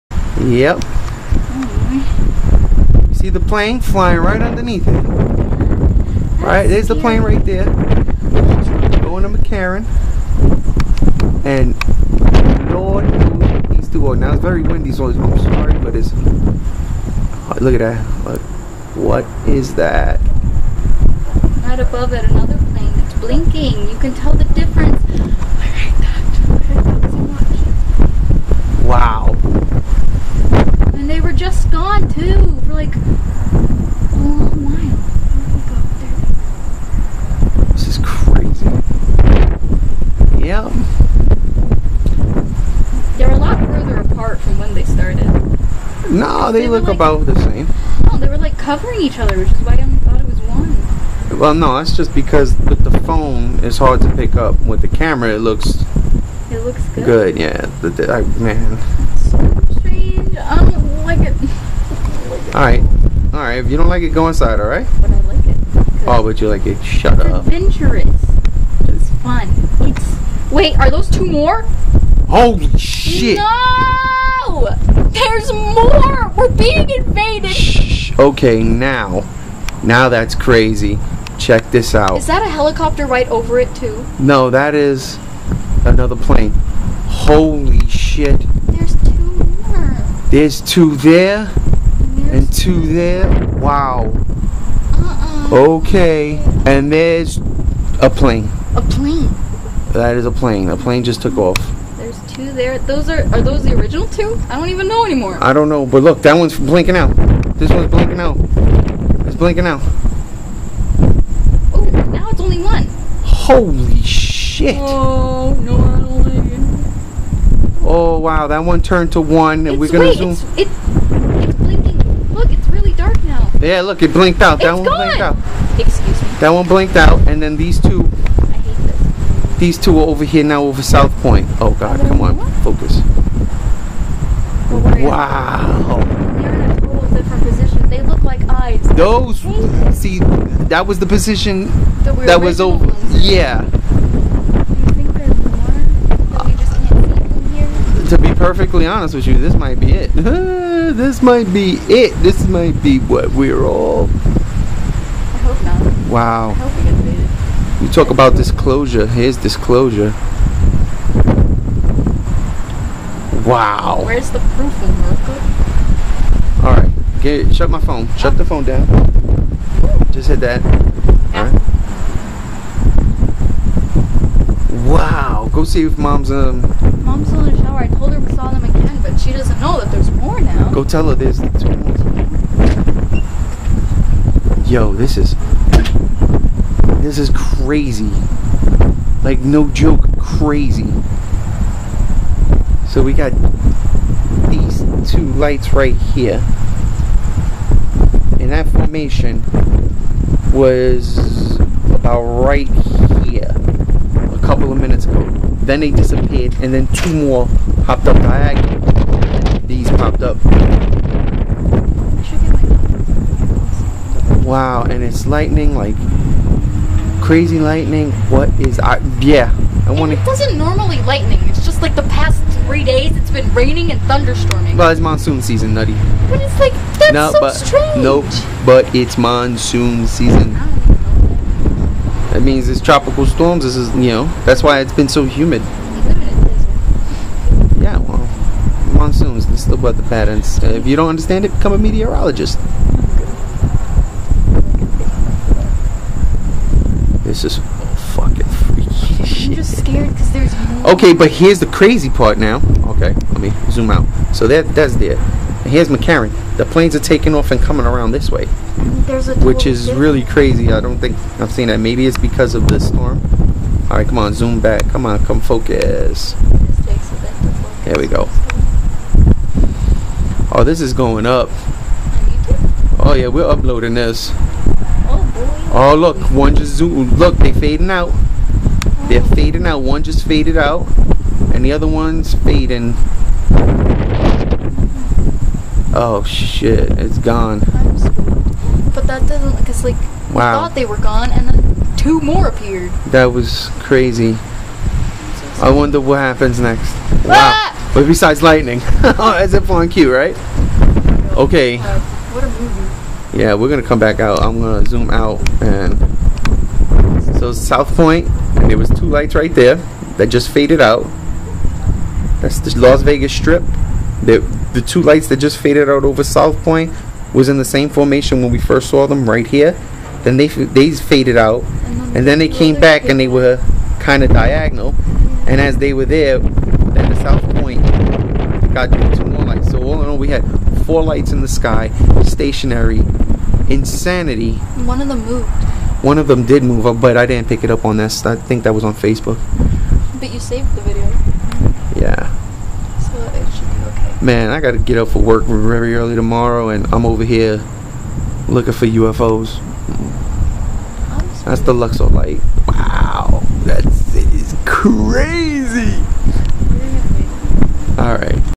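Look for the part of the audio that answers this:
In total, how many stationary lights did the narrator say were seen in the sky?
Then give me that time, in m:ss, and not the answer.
5:30.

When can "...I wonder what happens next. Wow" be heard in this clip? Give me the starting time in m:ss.
4:55.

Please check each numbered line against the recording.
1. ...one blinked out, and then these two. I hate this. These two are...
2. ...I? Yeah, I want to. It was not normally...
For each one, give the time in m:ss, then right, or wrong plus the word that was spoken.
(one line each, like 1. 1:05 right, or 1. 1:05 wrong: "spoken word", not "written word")
1. 2:06 right
2. 3:38 right.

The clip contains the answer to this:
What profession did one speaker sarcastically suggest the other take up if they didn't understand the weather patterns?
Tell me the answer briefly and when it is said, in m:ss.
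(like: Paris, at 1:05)
meteorologist, at 4:01.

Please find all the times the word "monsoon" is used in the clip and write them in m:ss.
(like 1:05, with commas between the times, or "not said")
3:44, 3:49, 3:58.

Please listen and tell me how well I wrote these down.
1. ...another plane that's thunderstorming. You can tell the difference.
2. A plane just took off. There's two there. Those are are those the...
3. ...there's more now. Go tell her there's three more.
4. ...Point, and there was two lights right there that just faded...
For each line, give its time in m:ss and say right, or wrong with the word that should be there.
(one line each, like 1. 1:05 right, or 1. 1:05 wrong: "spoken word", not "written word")
1. 0:22 wrong: "blinking", not "thunderstorming"
2. 1:40 right
3. 2:59 wrong: "two", not "three"
4. 5:07 right.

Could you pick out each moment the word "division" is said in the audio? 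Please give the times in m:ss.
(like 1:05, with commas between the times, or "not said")
not said.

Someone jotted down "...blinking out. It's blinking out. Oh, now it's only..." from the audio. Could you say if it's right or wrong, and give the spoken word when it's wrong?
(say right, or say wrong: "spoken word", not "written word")
right.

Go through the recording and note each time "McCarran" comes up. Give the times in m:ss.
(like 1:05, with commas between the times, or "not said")
0:09, 4:15.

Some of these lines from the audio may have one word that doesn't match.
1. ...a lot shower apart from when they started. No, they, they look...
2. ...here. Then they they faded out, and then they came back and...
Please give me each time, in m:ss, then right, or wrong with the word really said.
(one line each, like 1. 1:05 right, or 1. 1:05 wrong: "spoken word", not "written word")
1. 0:43 wrong: "further", not "shower"
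2. 5:19 right.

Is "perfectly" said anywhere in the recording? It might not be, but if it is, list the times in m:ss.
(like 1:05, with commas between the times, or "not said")
2:28.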